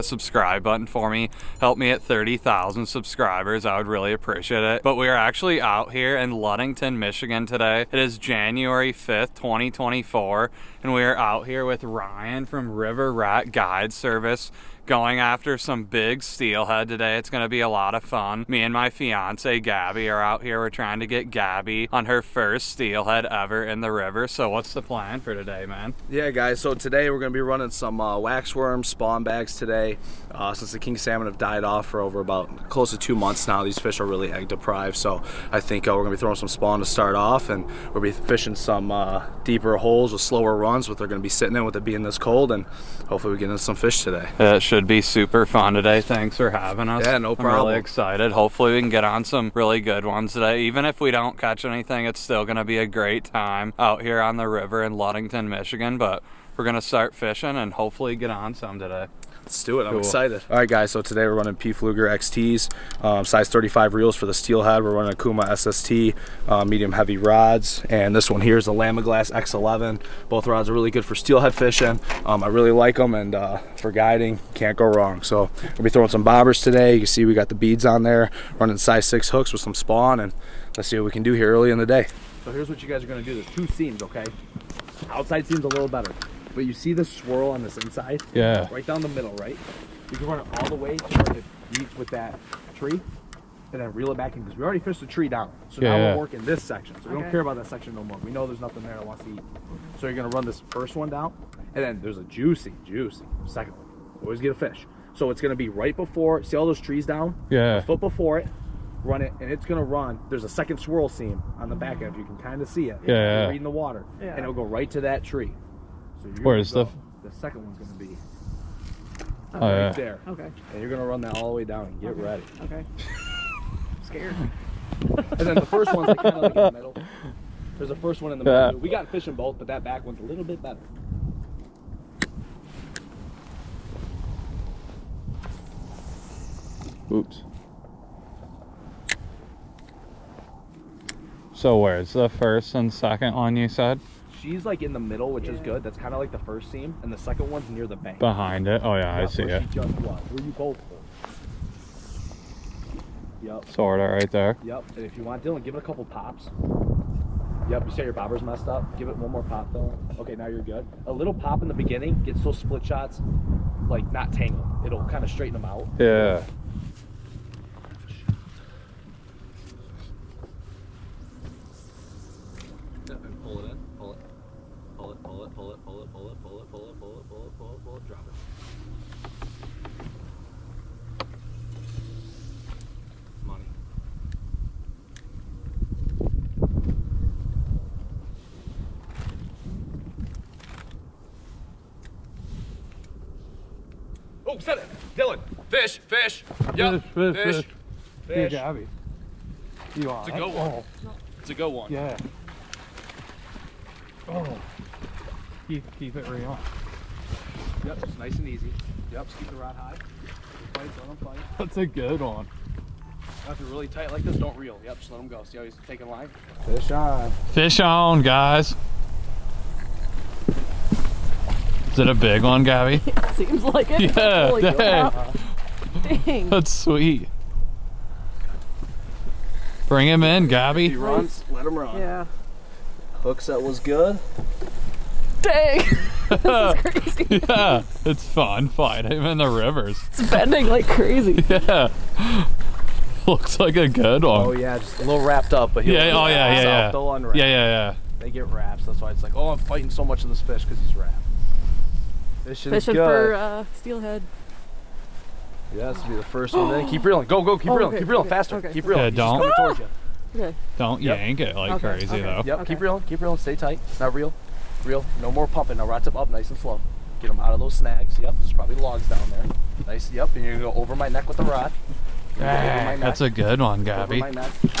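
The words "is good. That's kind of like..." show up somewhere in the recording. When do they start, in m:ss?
2:25.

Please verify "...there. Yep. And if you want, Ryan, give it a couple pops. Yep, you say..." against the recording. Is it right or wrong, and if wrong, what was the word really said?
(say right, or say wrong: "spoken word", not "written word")
wrong: "Dylan", not "Ryan".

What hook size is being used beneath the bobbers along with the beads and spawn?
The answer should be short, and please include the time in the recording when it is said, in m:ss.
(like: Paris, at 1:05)
6, at 1:18.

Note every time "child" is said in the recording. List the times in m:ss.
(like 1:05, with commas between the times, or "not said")
not said.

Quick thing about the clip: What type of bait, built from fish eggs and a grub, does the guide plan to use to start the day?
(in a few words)
waxworm spawn bags.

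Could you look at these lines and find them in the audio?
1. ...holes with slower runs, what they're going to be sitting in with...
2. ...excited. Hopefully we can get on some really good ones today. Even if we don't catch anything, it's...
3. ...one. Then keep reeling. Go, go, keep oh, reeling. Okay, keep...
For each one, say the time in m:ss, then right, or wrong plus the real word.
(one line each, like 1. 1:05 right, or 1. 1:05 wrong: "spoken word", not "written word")
1. 0:39 right
2. 0:47 right
3. 4:16 right.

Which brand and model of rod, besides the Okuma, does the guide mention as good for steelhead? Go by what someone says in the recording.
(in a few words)
Lamiglas X11.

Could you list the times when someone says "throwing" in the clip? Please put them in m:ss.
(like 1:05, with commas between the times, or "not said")
0:36, 1:15.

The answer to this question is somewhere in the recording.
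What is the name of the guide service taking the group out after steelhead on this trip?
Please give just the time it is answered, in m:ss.
0:12.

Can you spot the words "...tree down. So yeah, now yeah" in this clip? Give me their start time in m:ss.
1:35.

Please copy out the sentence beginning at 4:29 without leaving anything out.
Nice, yep, and you're gonna go over my neck with the rod.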